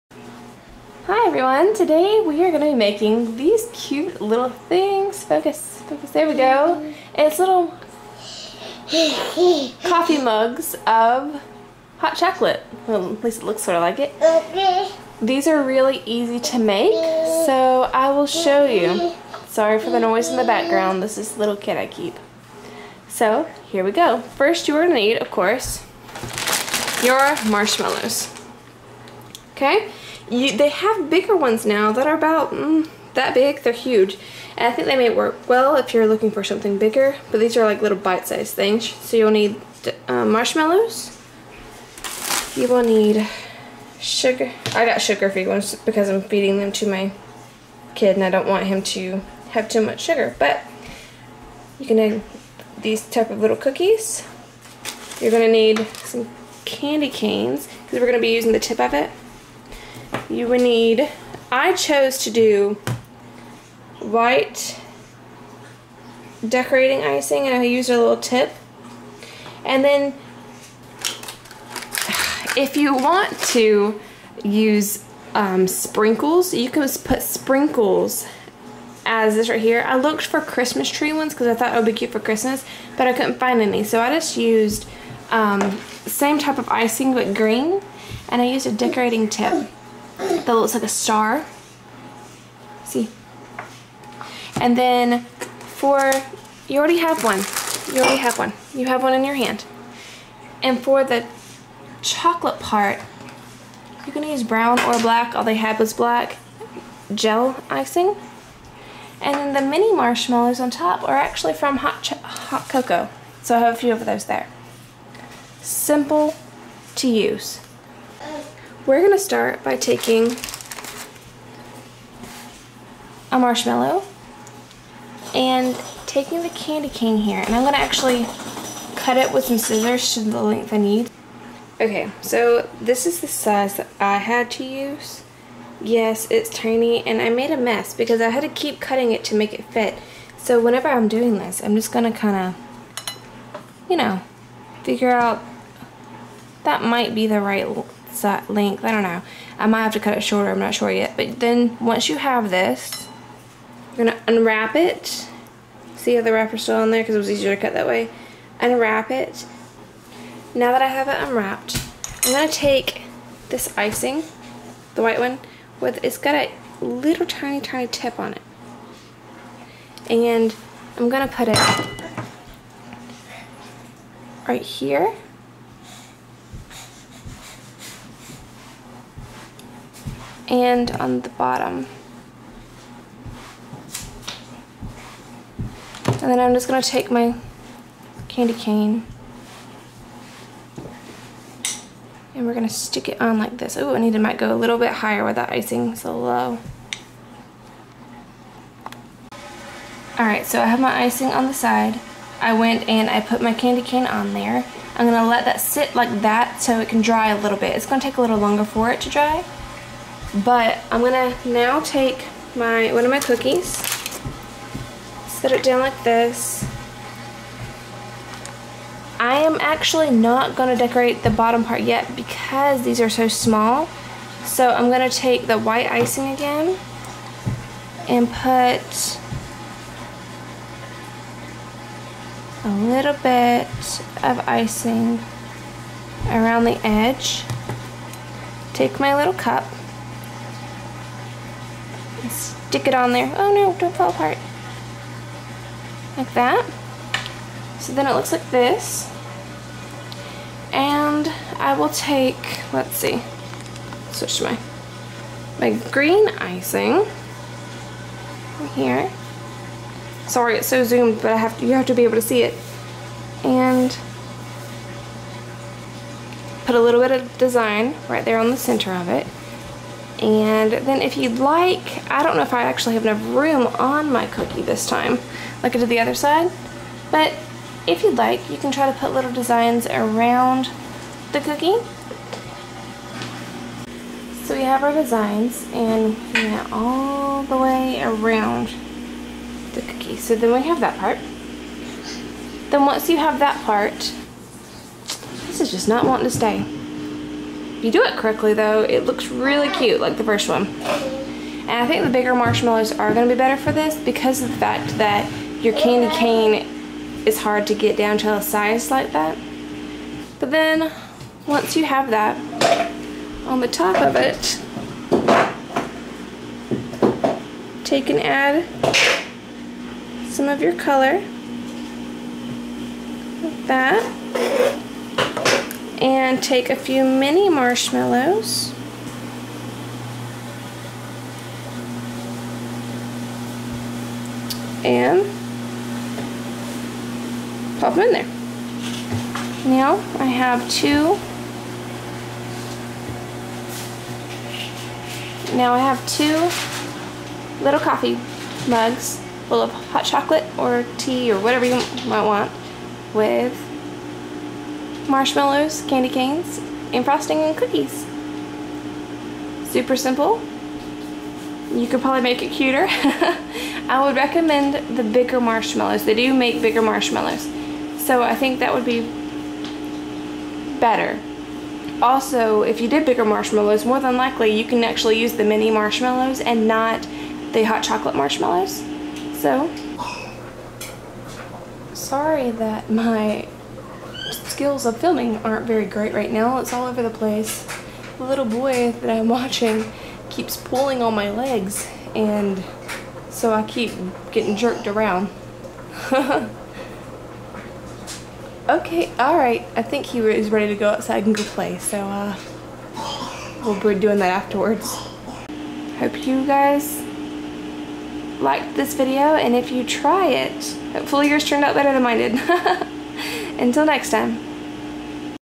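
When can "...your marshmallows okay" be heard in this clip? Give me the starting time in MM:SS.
00:27.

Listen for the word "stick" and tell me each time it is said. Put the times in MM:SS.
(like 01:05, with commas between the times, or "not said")
03:12, 04:02.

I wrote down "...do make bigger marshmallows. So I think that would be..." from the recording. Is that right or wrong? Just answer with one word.
right.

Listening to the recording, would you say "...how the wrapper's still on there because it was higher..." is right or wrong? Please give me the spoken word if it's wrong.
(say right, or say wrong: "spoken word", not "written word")
wrong: "easier", not "higher".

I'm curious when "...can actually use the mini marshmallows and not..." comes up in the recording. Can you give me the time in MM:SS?
06:14.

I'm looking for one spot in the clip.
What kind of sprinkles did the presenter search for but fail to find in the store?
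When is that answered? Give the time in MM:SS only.
01:20.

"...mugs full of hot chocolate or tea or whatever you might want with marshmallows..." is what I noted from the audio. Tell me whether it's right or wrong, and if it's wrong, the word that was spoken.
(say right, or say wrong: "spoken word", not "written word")
right.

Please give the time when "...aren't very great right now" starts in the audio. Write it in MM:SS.
06:25.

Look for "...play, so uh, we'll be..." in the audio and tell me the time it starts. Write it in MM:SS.
06:41.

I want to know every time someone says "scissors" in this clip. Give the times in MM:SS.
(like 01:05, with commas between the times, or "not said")
02:09.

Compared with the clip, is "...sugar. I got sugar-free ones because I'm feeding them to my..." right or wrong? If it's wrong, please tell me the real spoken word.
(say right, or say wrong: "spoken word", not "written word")
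right.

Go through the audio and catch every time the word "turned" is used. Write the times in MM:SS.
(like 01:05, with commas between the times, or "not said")
06:51.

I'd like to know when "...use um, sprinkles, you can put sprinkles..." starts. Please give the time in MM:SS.
01:14.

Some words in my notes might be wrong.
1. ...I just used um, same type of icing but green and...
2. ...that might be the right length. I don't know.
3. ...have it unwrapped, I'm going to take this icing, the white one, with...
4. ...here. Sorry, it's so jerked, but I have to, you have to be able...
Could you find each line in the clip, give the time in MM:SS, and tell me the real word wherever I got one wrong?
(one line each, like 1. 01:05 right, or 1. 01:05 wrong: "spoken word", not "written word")
1. 01:23 right
2. 02:26 right
3. 02:40 right
4. 04:18 wrong: "zoomed", not "jerked".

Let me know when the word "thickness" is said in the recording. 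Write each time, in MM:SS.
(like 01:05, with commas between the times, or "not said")
not said.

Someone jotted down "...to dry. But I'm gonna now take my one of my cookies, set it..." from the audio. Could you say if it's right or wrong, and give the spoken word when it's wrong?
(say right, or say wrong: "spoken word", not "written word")
right.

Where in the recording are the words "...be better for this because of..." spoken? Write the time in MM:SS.
05:03.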